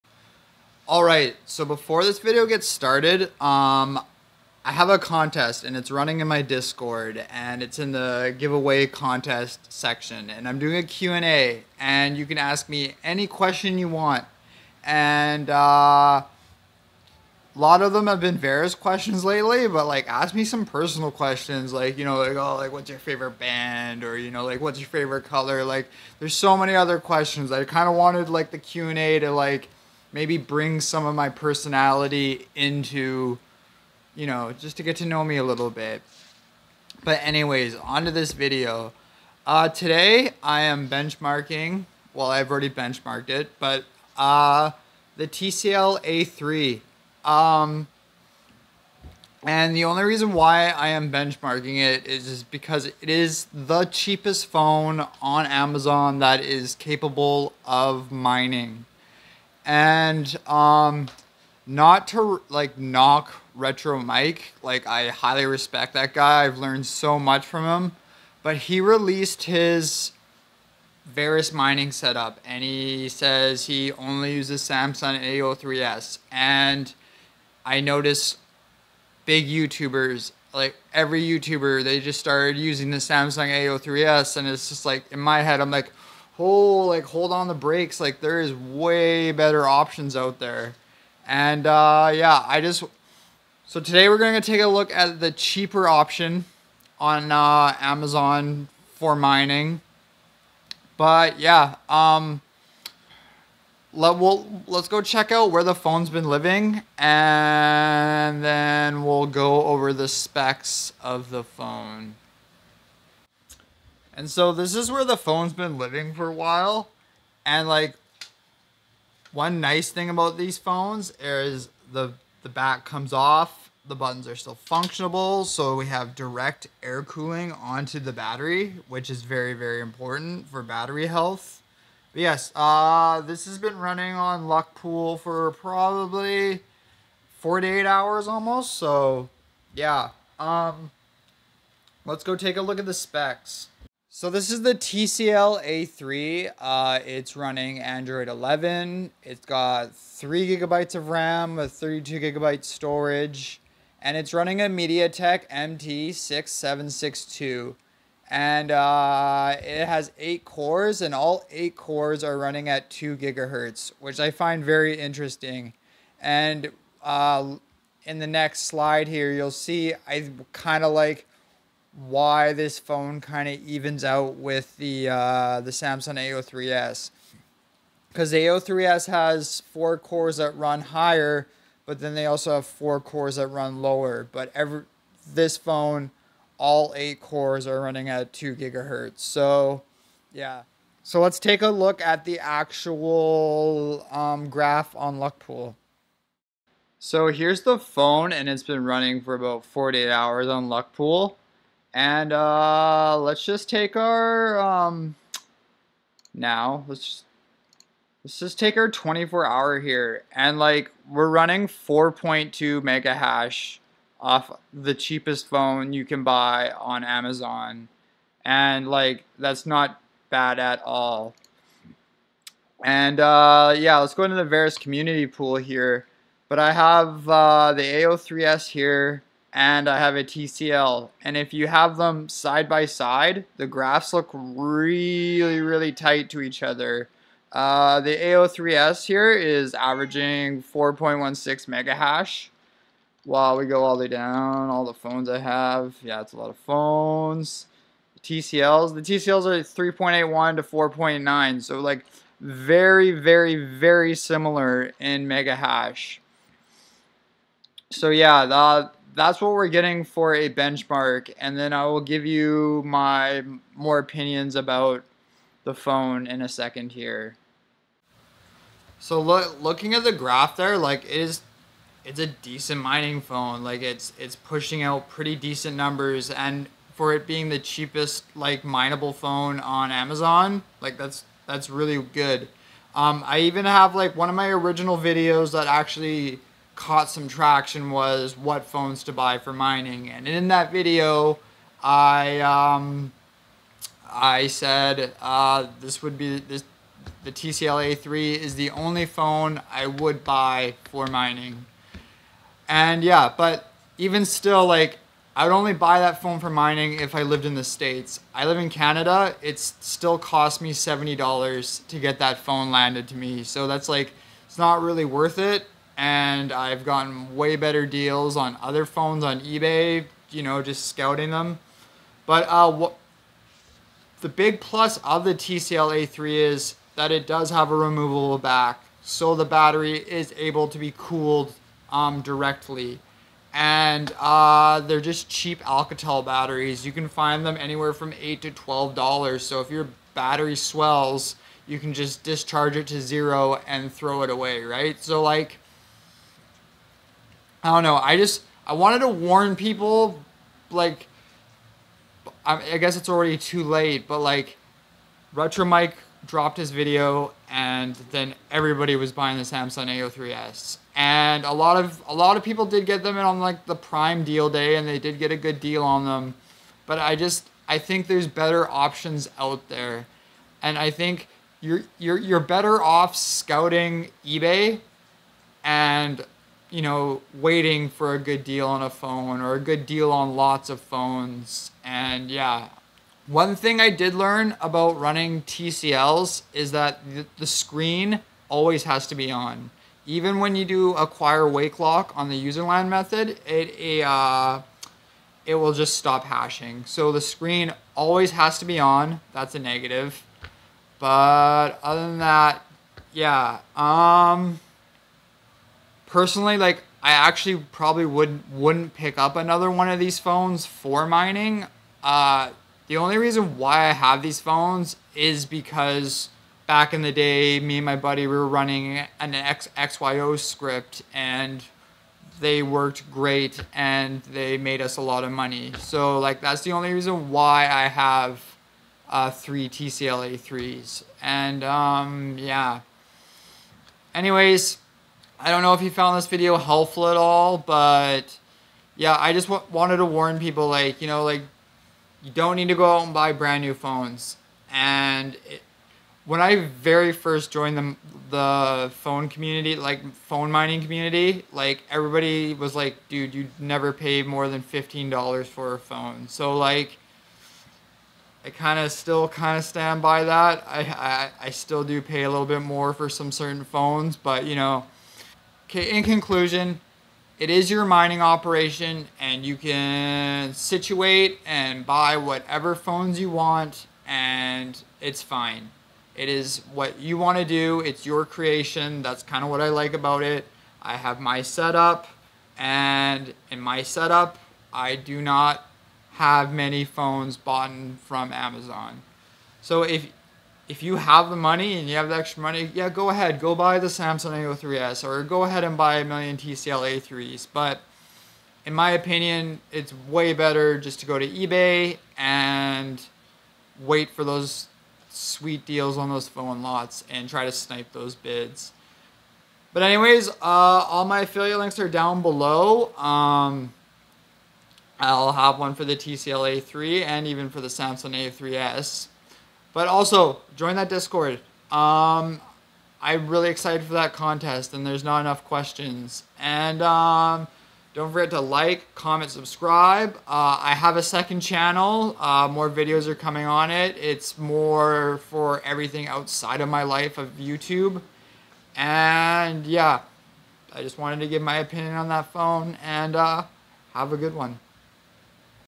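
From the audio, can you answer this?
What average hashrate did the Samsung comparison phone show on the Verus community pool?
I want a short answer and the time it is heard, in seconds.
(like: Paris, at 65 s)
4.16 mega hash, at 240 s.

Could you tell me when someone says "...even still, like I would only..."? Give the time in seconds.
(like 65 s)
303 s.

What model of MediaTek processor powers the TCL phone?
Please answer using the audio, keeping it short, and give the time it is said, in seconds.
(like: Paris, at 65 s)
MT6762, at 155 s.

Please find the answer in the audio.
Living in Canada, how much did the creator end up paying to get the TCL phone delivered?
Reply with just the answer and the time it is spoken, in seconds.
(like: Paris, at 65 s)
$70, at 310 s.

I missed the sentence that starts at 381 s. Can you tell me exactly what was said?
And yeah, one thing I did learn about running TCLs is that the screen always has to be on.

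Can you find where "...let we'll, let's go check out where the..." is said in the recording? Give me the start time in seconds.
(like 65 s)
103 s.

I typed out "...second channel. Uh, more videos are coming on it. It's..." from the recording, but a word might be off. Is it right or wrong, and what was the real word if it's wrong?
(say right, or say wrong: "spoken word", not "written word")
right.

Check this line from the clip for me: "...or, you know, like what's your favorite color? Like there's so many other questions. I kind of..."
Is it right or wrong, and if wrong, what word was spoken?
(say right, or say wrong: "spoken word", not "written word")
right.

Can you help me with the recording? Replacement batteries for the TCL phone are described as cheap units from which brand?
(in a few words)
Alcatel.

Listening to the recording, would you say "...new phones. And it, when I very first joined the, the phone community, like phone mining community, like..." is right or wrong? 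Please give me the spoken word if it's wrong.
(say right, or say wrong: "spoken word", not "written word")
right.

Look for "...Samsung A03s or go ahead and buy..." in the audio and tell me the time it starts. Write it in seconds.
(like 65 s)
493 s.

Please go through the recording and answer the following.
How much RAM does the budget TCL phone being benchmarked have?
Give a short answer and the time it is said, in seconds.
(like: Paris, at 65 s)
3 gigabytes, at 149 s.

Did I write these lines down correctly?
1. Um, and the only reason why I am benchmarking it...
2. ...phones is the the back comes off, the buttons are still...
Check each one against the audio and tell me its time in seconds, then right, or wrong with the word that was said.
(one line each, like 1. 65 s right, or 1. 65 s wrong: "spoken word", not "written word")
1. 47 s right
2. 120 s right.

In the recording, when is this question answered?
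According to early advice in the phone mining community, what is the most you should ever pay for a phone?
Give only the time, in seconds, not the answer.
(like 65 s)
454 s.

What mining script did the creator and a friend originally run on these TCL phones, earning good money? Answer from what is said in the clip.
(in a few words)
XYO.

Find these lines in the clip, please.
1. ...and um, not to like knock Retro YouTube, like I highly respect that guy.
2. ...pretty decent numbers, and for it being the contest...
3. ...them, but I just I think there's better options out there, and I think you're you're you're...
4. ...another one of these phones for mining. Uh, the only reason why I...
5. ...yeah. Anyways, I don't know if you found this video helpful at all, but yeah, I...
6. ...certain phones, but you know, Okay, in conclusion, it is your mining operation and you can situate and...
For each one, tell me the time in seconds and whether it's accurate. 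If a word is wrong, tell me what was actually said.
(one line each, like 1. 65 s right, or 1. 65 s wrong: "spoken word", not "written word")
1. 59 s wrong: "Mike", not "YouTube"
2. 275 s wrong: "cheapest", not "contest"
3. 366 s right
4. 409 s right
5. 432 s right
6. 463 s right.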